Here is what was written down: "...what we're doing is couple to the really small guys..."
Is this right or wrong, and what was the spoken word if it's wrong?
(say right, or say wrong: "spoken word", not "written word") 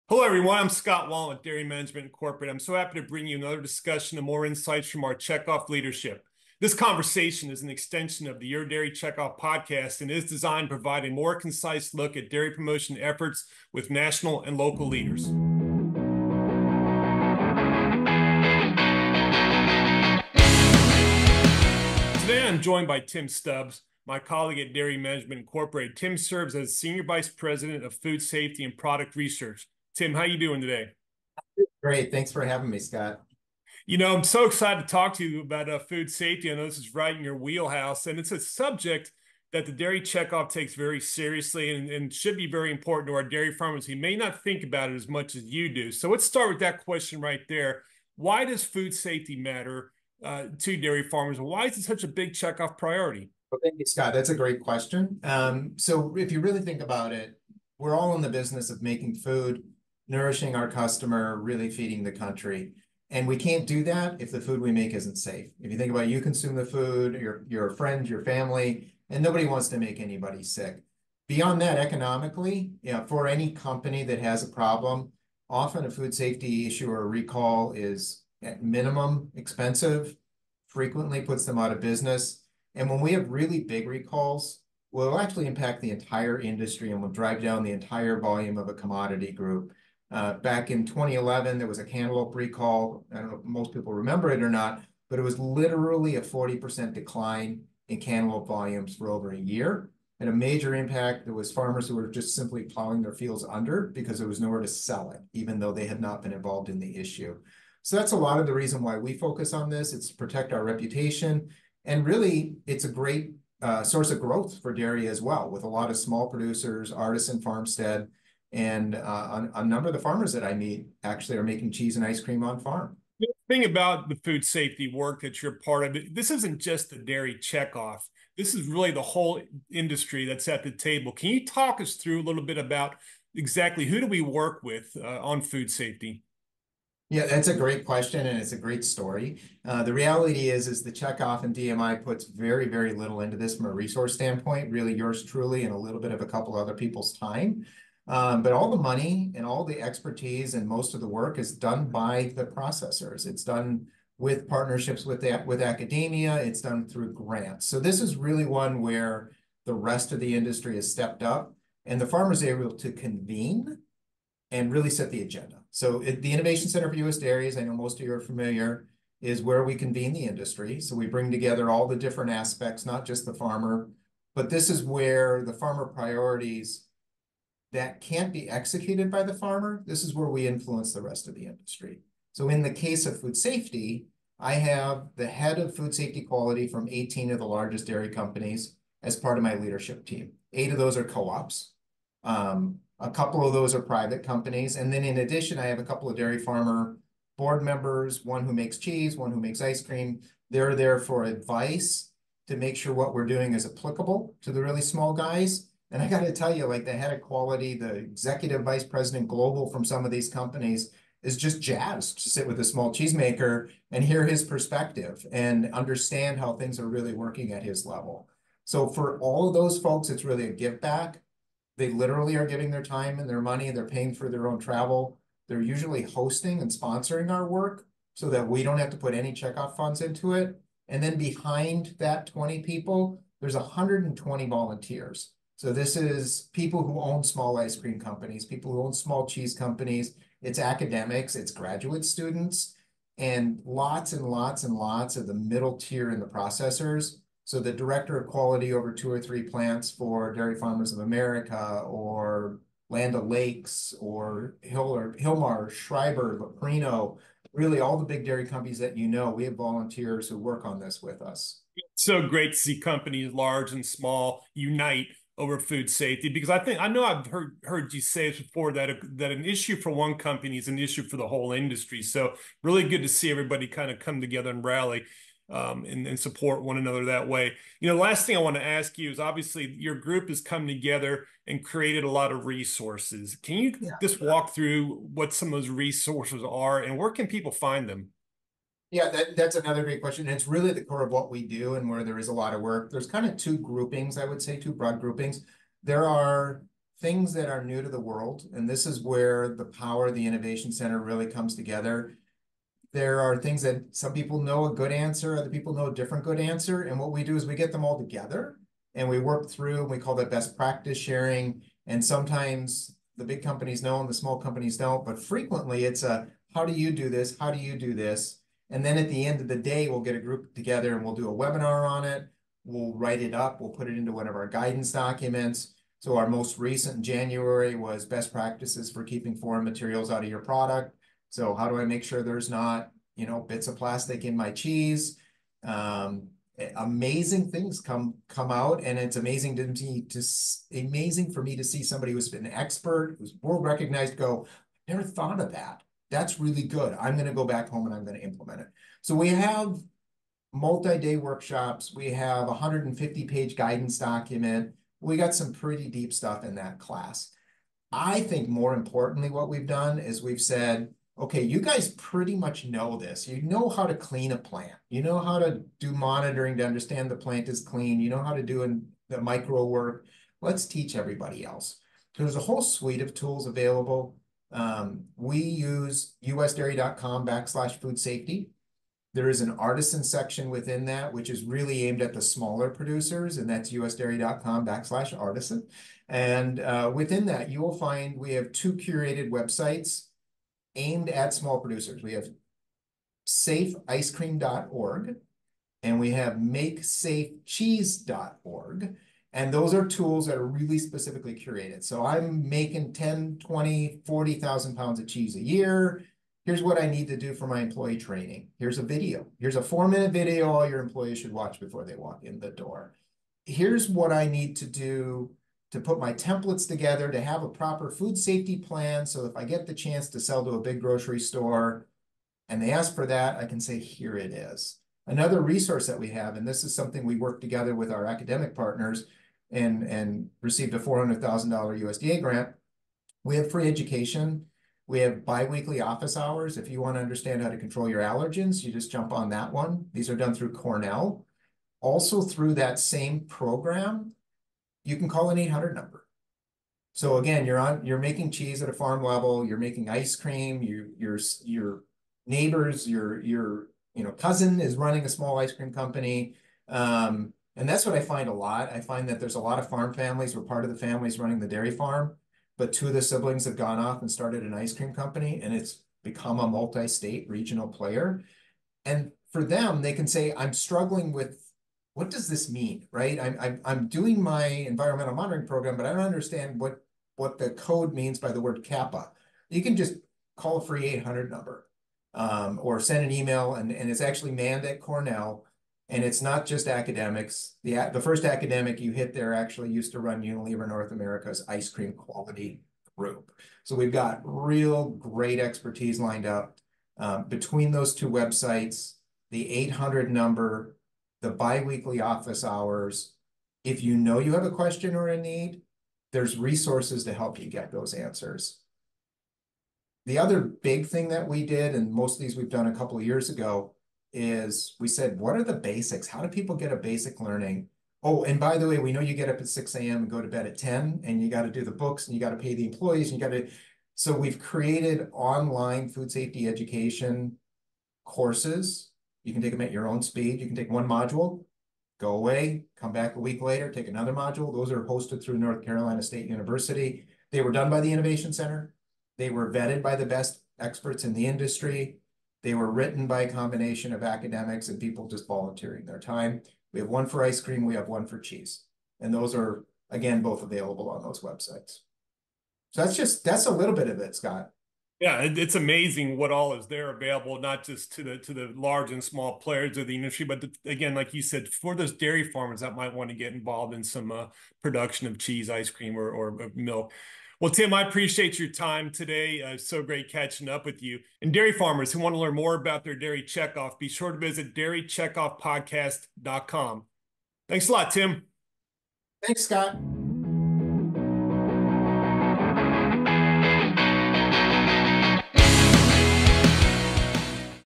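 wrong: "applicable", not "couple".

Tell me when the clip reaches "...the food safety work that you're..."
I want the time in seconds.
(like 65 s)
124 s.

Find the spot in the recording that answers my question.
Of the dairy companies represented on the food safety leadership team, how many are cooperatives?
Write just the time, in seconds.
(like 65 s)
190 s.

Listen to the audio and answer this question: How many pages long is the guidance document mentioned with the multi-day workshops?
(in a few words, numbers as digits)
150.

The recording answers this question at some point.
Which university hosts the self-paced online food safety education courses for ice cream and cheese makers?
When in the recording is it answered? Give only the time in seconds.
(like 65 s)
535 s.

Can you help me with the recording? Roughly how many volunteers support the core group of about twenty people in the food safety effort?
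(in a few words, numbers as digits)
120.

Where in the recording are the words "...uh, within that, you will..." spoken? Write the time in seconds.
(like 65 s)
386 s.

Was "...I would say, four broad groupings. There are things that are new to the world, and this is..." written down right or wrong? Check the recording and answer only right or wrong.
wrong.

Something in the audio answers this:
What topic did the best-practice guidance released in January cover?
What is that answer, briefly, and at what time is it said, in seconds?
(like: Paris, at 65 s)
Foreign materials, at 329 s.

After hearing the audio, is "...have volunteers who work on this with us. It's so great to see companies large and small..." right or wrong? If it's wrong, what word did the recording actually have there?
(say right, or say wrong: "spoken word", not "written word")
right.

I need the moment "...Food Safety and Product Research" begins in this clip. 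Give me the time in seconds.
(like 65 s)
27 s.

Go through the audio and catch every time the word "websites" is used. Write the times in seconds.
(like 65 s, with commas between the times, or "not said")
389 s, 498 s, 551 s.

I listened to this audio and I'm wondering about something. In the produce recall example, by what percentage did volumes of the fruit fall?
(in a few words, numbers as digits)
40%.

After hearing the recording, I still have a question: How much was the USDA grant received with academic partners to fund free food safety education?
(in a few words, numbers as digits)
$400,000.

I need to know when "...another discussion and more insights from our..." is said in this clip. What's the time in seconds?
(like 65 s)
3 s.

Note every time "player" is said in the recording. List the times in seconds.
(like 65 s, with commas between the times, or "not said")
467 s, 559 s.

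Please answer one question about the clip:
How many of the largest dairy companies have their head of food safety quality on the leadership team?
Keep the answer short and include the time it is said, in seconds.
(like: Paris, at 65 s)
18, at 186 s.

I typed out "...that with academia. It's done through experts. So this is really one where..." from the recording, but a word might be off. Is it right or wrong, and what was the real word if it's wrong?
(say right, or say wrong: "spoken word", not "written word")
wrong: "grants", not "experts".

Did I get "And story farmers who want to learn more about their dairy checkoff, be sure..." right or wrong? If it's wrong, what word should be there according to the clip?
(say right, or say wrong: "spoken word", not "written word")
wrong: "dairy", not "story".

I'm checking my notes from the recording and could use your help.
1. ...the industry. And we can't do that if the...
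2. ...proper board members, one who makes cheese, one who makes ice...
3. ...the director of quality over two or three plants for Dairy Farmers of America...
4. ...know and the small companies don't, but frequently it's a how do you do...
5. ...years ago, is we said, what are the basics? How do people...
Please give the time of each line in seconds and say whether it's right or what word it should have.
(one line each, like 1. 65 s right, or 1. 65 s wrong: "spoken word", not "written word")
1. 62 s wrong: "country", not "industry"
2. 196 s wrong: "farmer", not "proper"
3. 247 s right
4. 313 s right
5. 513 s right.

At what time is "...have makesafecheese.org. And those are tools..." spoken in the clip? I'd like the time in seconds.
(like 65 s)
396 s.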